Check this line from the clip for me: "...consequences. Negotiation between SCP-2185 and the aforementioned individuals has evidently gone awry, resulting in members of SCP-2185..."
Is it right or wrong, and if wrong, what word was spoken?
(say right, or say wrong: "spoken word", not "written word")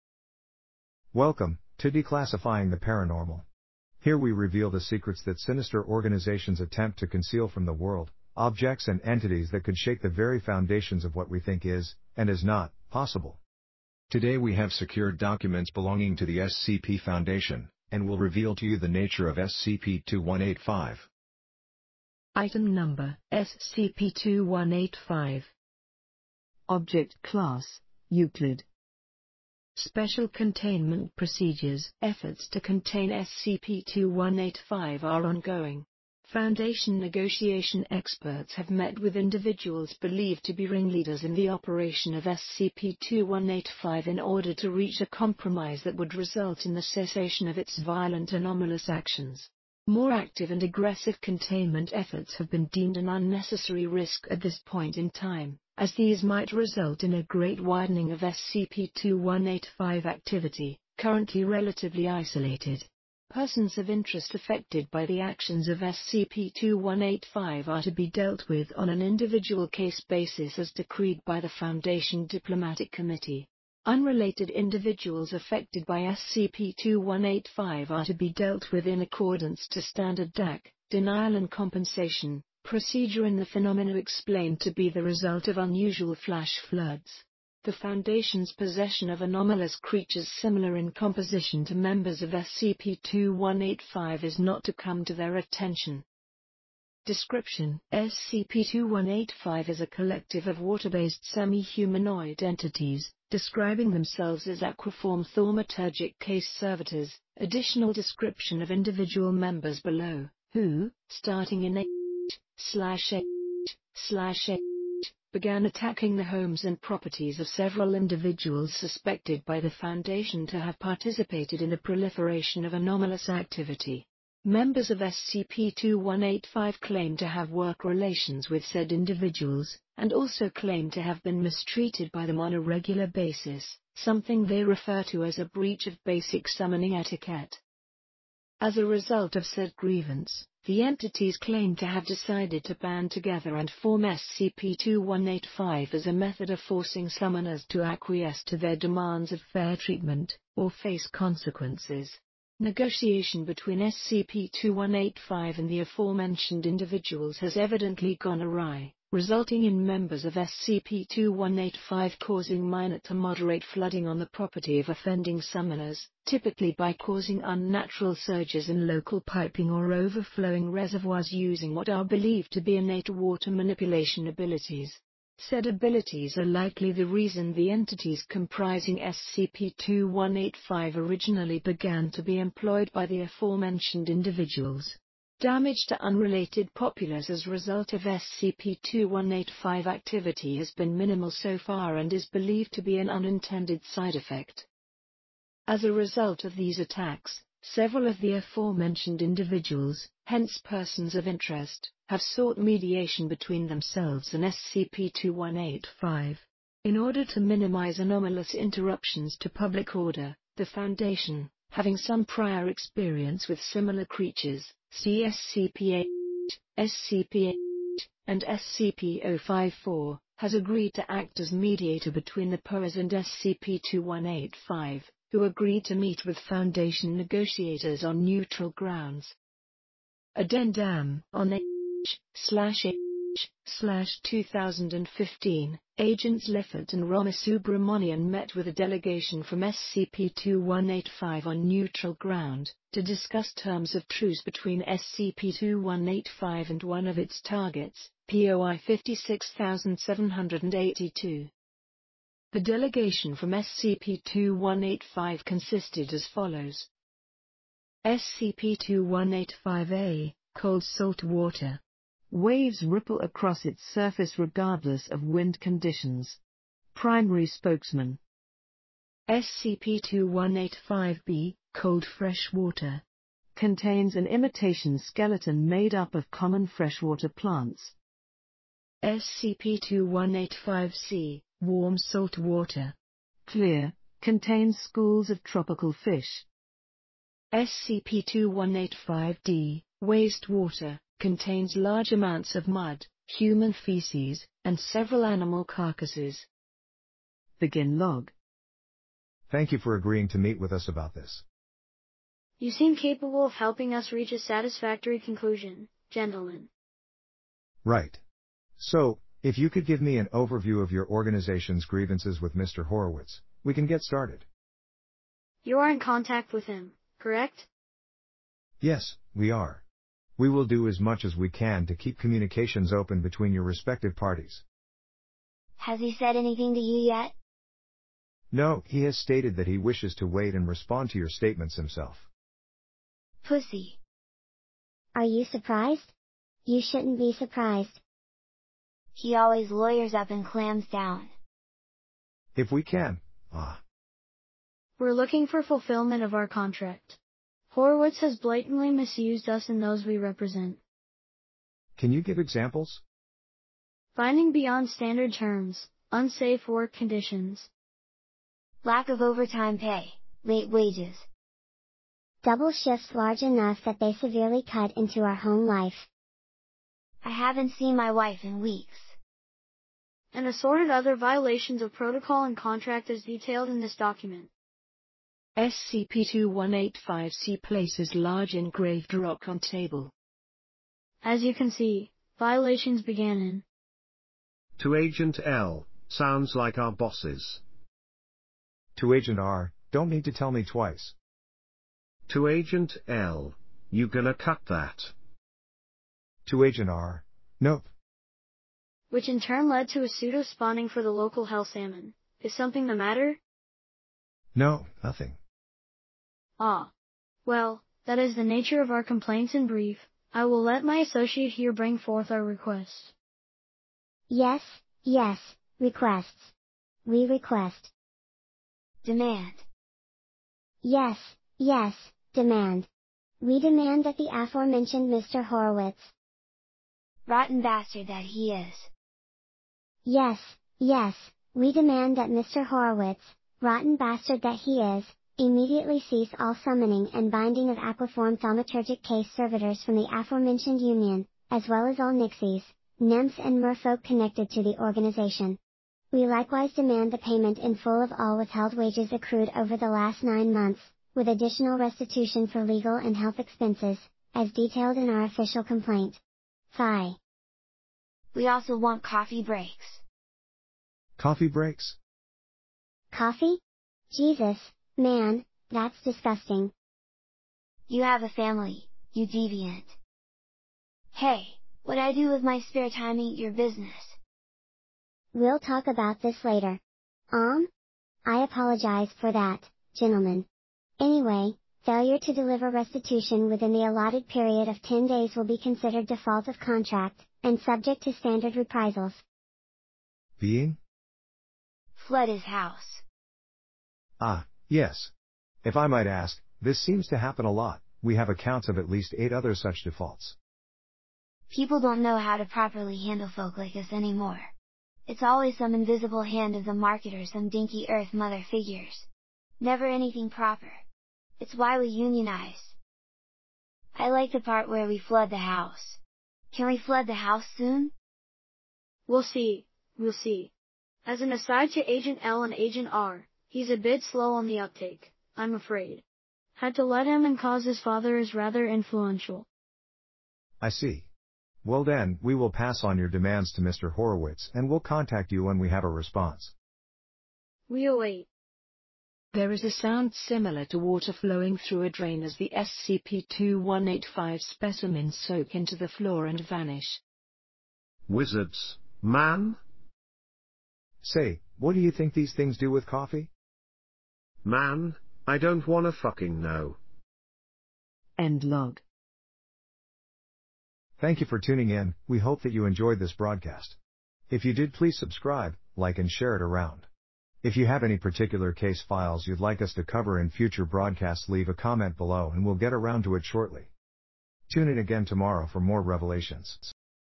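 right.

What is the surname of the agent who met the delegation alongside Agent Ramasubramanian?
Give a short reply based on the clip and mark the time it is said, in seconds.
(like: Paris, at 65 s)
Lifford, at 236 s.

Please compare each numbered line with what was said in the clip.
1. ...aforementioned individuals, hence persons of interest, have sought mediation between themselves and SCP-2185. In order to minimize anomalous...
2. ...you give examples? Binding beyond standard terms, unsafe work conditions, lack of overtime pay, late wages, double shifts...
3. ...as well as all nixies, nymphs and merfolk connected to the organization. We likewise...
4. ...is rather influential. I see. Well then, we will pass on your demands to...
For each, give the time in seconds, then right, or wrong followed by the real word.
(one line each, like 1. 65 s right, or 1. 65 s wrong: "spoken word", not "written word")
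1. 198 s right
2. 352 s right
3. 441 s right
4. 528 s right.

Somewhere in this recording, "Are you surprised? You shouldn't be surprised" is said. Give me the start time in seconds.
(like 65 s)
335 s.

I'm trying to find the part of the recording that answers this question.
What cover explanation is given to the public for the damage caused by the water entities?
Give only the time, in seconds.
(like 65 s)
85 s.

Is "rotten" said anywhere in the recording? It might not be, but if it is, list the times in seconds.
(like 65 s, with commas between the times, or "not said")
427 s, 433 s.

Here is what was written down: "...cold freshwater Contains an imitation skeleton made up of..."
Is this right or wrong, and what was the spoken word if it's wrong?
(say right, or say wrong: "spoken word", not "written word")
right.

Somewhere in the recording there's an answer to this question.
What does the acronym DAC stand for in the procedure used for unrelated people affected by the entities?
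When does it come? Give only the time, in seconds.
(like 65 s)
80 s.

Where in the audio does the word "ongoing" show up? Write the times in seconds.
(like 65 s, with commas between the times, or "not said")
35 s.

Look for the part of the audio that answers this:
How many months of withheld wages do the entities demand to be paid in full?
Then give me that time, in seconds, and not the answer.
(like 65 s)
450 s.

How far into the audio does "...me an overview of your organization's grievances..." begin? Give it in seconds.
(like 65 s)
310 s.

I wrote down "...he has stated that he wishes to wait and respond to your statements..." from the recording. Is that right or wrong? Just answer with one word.
right.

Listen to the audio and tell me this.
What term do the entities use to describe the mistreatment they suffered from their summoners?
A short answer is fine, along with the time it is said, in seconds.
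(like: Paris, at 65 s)
breach of basic summoning etiquette, at 135 s.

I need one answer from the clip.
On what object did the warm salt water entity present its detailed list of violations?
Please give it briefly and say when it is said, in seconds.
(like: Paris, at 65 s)
large engraved rock, at 378 s.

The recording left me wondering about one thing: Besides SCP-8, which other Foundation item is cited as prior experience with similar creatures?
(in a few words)
SCP-054.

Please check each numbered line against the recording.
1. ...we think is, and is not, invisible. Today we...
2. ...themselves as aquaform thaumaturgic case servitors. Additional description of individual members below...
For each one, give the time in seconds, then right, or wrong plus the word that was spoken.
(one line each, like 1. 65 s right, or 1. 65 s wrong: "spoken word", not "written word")
1. 11 s wrong: "possible", not "invisible"
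2. 103 s right.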